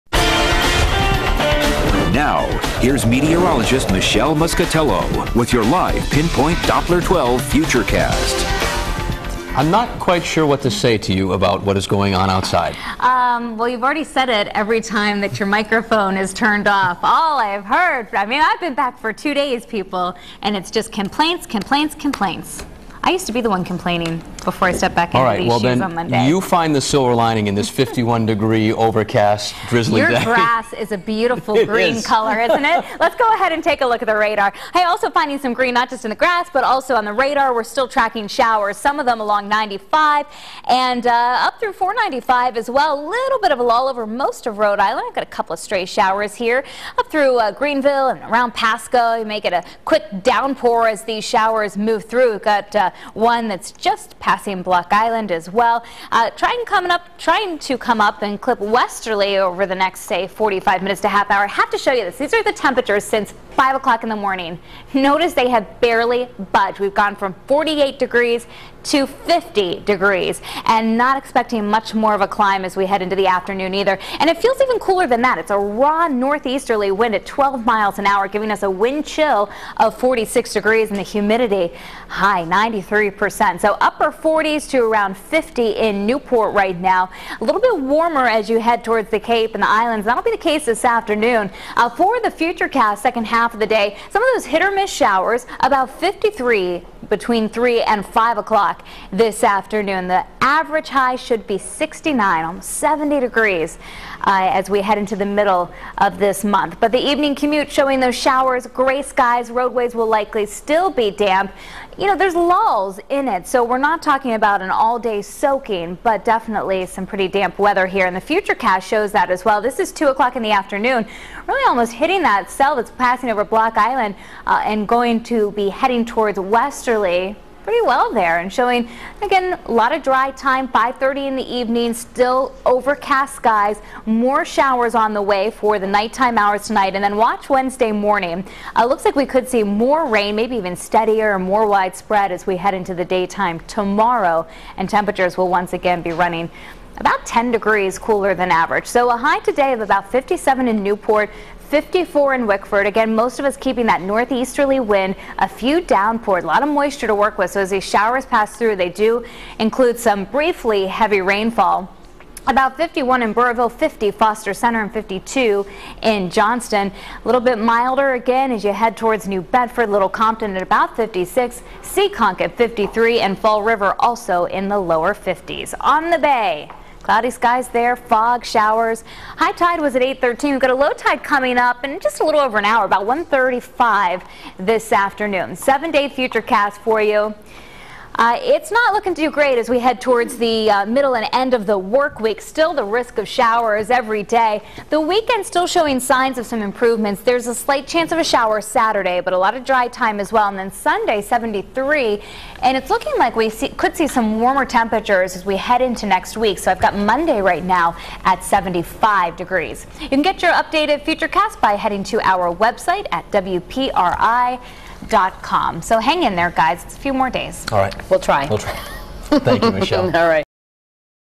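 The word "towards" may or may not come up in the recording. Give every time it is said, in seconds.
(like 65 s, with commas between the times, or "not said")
88 s, 126 s, 168 s, 190 s.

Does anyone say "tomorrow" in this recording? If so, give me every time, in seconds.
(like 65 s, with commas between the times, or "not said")
143 s.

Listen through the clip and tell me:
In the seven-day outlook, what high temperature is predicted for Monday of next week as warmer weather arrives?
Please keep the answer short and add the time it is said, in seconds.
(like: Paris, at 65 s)
75 degrees, at 208 s.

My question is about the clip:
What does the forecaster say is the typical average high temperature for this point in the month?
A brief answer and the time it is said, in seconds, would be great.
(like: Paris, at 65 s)
69, at 101 s.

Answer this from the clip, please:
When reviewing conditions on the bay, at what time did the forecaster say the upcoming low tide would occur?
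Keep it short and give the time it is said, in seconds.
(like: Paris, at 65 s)
1:35, at 183 s.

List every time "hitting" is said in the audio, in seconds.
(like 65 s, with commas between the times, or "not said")
121 s.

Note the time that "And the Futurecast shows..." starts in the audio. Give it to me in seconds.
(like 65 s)
118 s.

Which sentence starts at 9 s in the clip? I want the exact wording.
I'm not quite sure what to say to you about what is going on outside.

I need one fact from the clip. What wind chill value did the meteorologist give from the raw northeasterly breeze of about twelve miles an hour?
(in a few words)
46 degrees.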